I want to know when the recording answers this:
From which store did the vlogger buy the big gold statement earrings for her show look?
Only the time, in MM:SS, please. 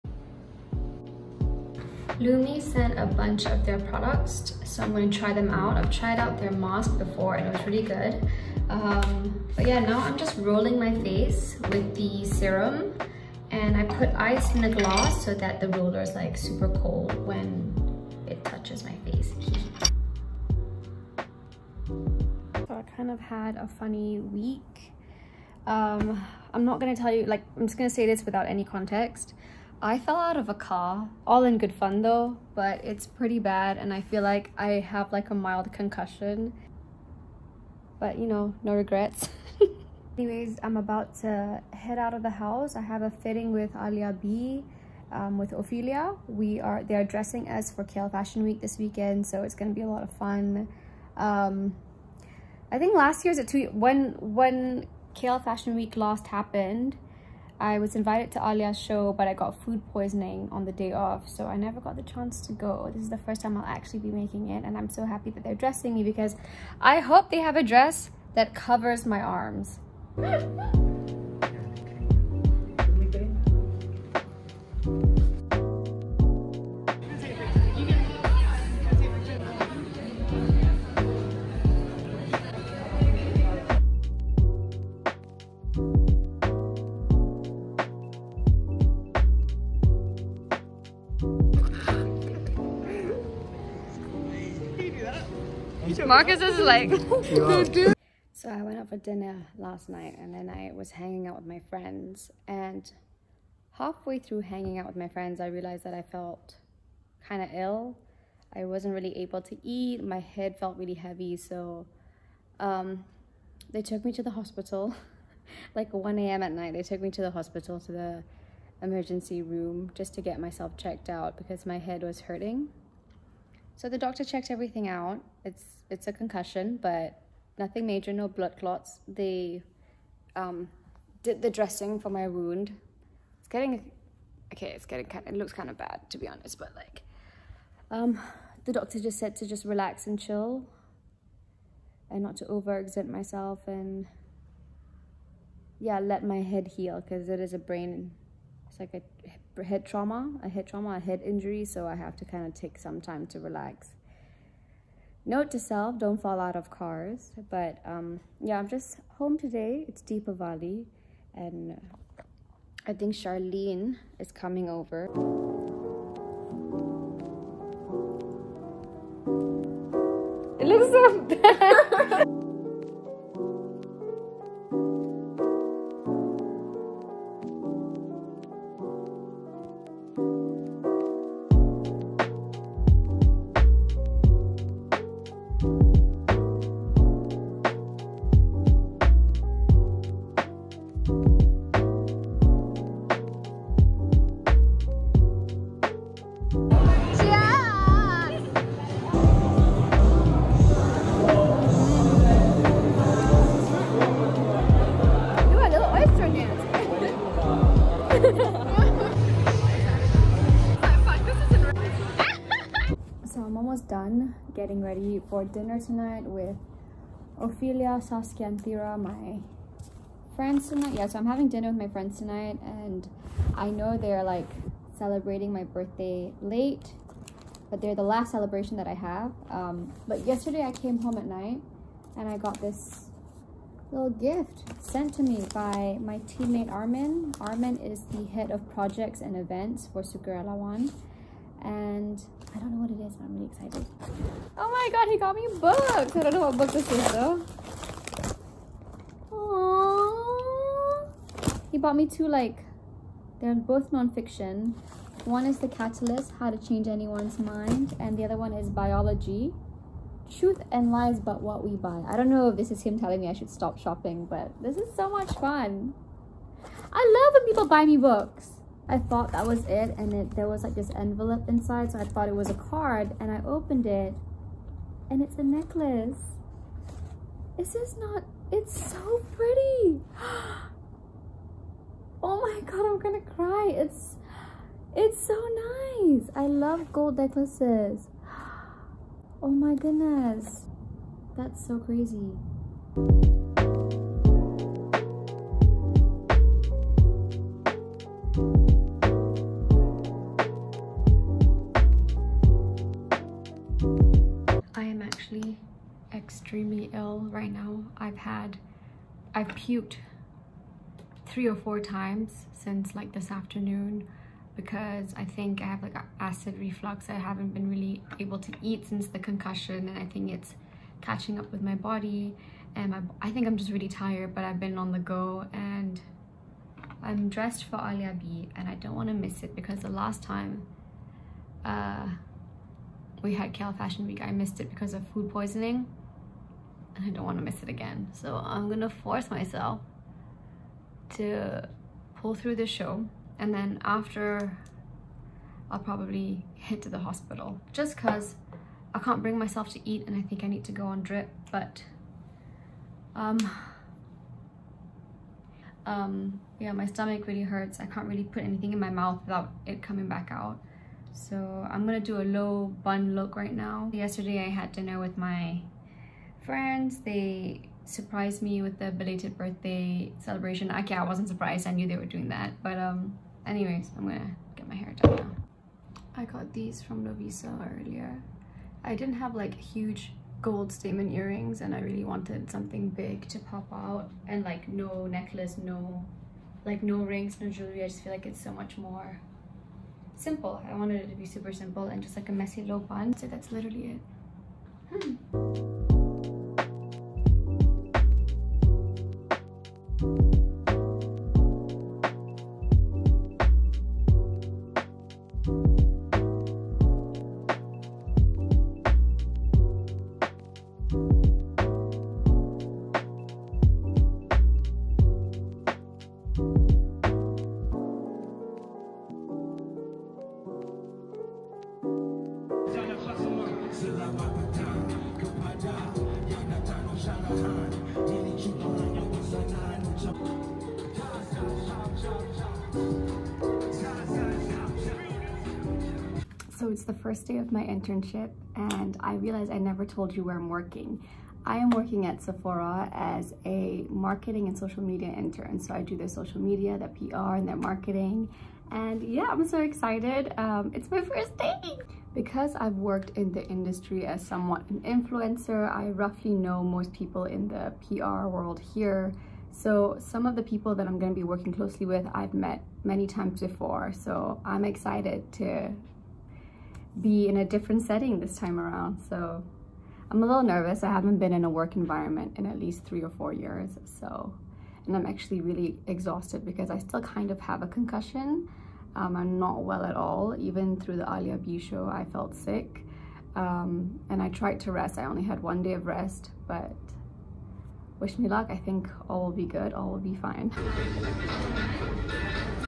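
06:17.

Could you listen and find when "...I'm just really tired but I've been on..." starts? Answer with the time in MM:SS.
05:23.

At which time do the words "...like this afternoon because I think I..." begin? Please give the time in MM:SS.
05:12.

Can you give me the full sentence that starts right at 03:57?
Armin is the head of projects and events for One and I don't know what it is, but I'm really excited.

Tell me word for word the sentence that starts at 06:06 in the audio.
They surprised me with the belated birthday celebration.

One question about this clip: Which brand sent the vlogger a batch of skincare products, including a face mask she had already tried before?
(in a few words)
Lumi.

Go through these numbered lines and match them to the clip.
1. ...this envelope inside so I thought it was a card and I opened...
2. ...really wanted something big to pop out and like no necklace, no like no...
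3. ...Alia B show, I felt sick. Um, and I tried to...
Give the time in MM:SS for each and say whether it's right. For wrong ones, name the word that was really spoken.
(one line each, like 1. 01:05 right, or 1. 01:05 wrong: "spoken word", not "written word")
1. 04:30 right
2. 06:21 right
3. 08:01 right.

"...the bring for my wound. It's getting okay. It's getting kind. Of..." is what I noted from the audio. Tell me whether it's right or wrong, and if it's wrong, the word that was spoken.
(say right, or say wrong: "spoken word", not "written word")
wrong: "dressing", not "bring".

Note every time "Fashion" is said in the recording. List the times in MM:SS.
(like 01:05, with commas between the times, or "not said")
00:48, 00:55, 05:33.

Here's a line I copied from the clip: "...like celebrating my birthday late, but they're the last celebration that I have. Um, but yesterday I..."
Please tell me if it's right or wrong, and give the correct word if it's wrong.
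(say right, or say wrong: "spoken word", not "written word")
right.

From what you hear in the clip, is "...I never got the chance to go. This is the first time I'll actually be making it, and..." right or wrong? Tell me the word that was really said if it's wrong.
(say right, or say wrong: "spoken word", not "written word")
right.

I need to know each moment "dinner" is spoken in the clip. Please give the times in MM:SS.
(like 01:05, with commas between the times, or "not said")
01:38, 03:35, 03:41, 06:04.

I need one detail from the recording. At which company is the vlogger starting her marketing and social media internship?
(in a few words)
Sephora.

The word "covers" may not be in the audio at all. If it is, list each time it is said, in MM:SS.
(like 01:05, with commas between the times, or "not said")
01:08.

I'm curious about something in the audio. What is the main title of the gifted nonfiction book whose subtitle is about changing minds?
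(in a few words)
The Catalyst.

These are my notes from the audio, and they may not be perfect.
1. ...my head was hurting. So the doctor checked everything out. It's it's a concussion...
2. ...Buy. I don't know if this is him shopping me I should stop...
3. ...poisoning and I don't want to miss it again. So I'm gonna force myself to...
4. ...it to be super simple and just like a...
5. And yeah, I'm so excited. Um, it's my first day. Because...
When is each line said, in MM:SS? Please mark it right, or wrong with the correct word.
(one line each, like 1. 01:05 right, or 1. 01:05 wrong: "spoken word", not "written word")
1. 02:01 right
2. 04:21 wrong: "telling", not "shopping"
3. 05:35 right
4. 06:31 right
5. 07:28 right.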